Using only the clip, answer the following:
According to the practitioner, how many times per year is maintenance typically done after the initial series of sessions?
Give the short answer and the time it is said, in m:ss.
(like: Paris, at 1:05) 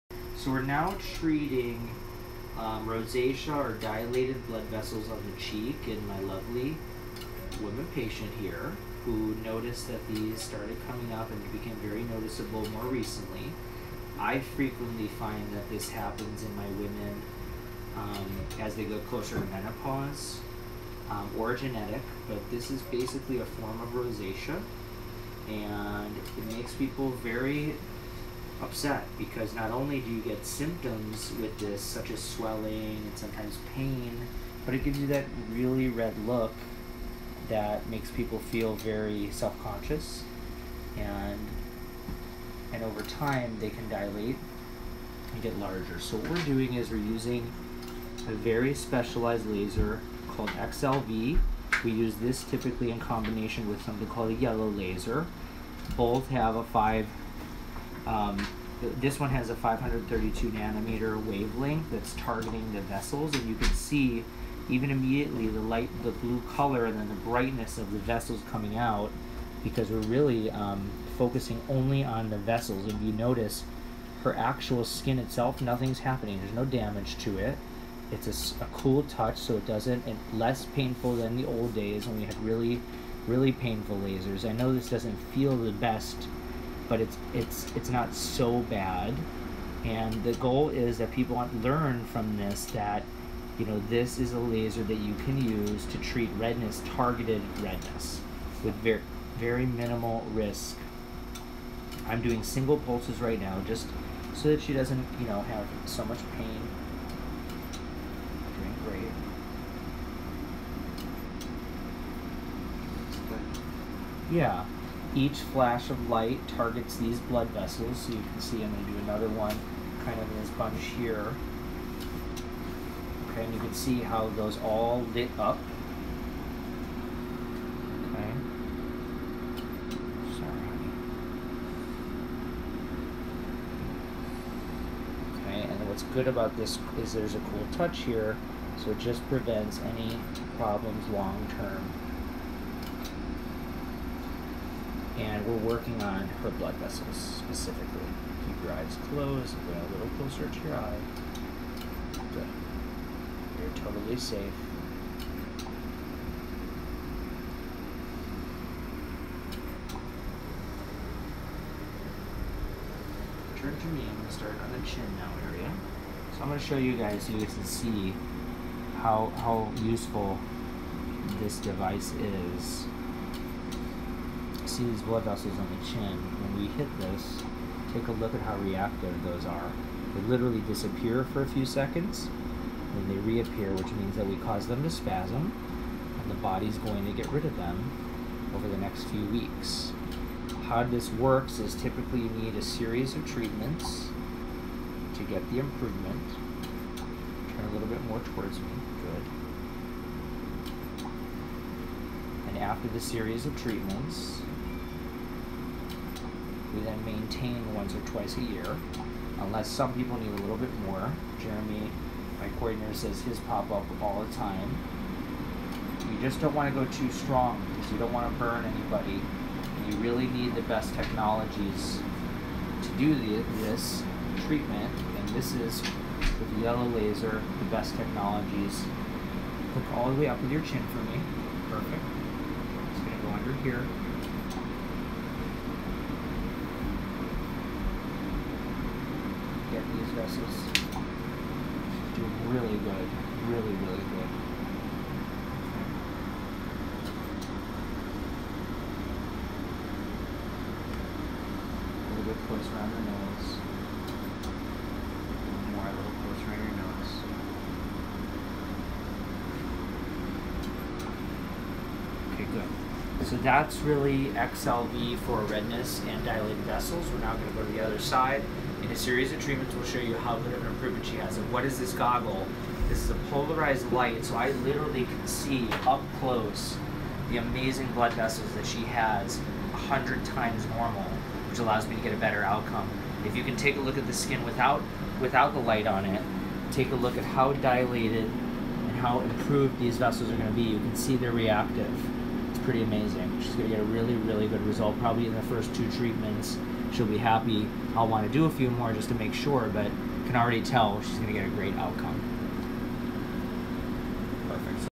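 once or twice, at 3:27.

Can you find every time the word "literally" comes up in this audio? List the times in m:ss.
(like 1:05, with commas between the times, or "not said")
3:00, 4:34.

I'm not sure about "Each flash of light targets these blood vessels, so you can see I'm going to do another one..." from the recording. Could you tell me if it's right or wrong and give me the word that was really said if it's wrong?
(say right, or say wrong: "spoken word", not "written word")
right.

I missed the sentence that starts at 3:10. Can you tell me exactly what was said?
How this works is typically you need a series of treatments to get the improvement.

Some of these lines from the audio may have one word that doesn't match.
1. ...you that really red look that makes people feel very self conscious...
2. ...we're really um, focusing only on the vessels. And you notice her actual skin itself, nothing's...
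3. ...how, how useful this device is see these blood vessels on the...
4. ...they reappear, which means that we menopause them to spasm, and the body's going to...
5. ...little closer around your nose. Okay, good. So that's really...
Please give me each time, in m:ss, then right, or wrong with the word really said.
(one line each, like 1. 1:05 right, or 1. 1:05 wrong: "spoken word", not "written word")
1. 0:34 right
2. 1:09 right
3. 2:49 right
4. 3:03 wrong: "cause", not "menopause"
5. 4:15 right.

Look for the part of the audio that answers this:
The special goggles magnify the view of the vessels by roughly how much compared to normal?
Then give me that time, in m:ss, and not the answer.
4:39.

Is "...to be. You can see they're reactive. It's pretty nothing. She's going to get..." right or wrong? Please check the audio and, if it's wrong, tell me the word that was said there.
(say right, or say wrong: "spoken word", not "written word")
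wrong: "amazing", not "nothing".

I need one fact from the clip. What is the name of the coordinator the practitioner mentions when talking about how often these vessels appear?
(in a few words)
Jeremy.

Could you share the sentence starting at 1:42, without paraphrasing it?
I'm doing single pulses right now just so that she doesn't you know have so much pain.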